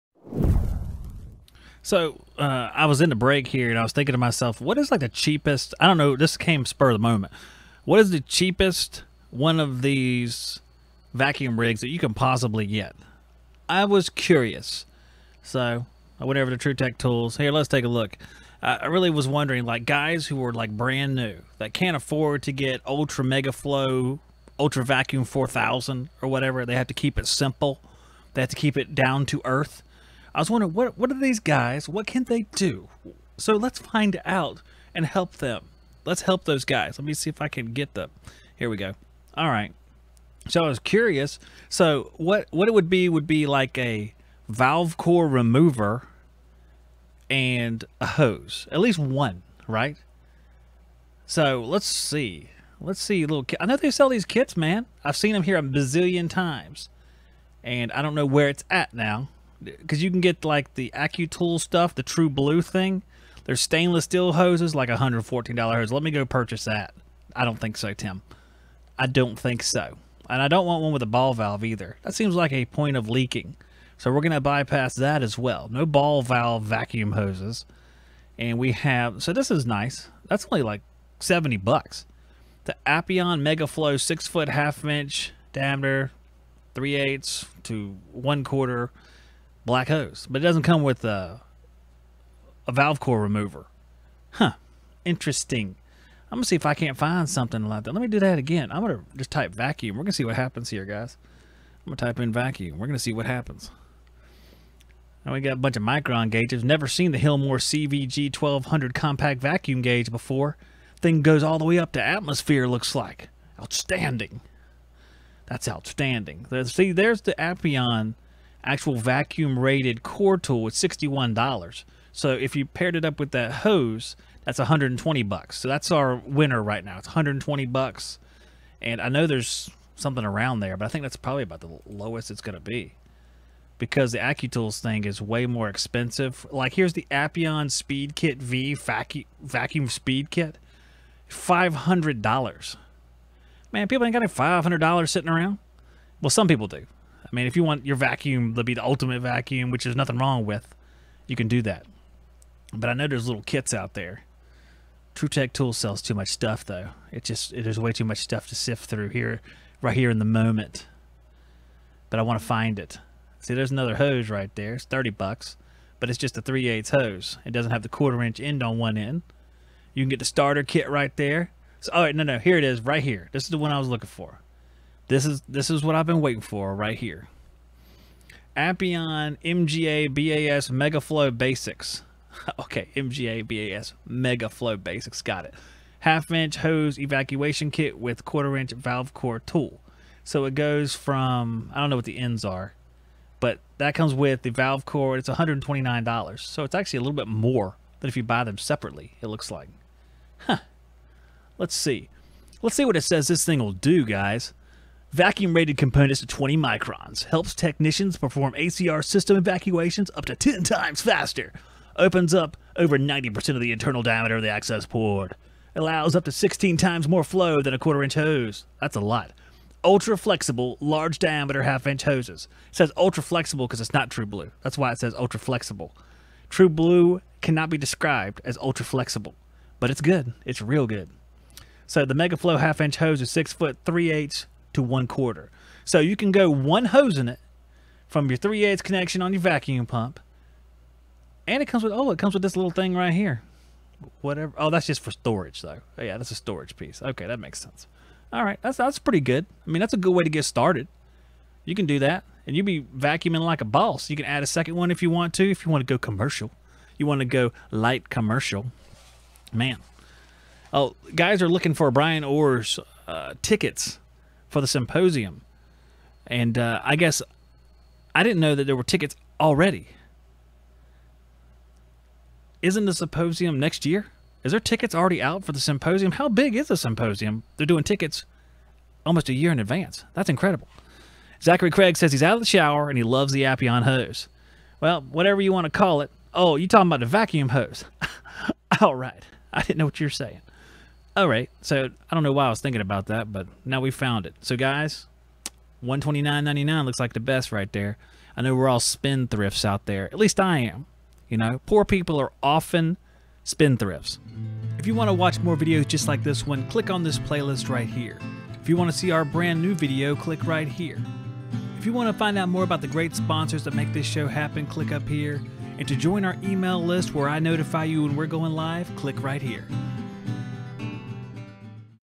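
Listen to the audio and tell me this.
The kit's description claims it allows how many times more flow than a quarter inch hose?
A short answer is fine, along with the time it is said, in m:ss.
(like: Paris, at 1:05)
16 times, at 3:36.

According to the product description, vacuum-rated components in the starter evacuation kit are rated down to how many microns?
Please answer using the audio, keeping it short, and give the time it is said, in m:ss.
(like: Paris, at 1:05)
20 microns, at 3:26.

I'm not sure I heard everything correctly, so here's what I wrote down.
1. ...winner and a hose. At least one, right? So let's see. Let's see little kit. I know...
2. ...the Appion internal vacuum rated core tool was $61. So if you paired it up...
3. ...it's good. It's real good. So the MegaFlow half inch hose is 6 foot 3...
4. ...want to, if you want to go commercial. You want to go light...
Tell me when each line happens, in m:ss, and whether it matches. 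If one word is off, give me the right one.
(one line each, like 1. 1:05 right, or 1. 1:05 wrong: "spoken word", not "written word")
1. 0:45 wrong: "remover", not "winner"
2. 1:57 wrong: "actual", not "internal"
3. 3:49 right
4. 4:15 right.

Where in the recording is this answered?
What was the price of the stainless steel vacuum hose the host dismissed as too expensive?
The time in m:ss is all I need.
1:04.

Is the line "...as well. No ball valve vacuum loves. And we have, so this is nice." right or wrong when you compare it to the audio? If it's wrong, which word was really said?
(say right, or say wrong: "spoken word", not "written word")
wrong: "hoses", not "loves".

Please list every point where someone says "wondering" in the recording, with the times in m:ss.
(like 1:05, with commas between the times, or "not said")
0:19, 0:30.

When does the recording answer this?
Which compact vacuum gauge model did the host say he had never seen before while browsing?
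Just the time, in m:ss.
1:47.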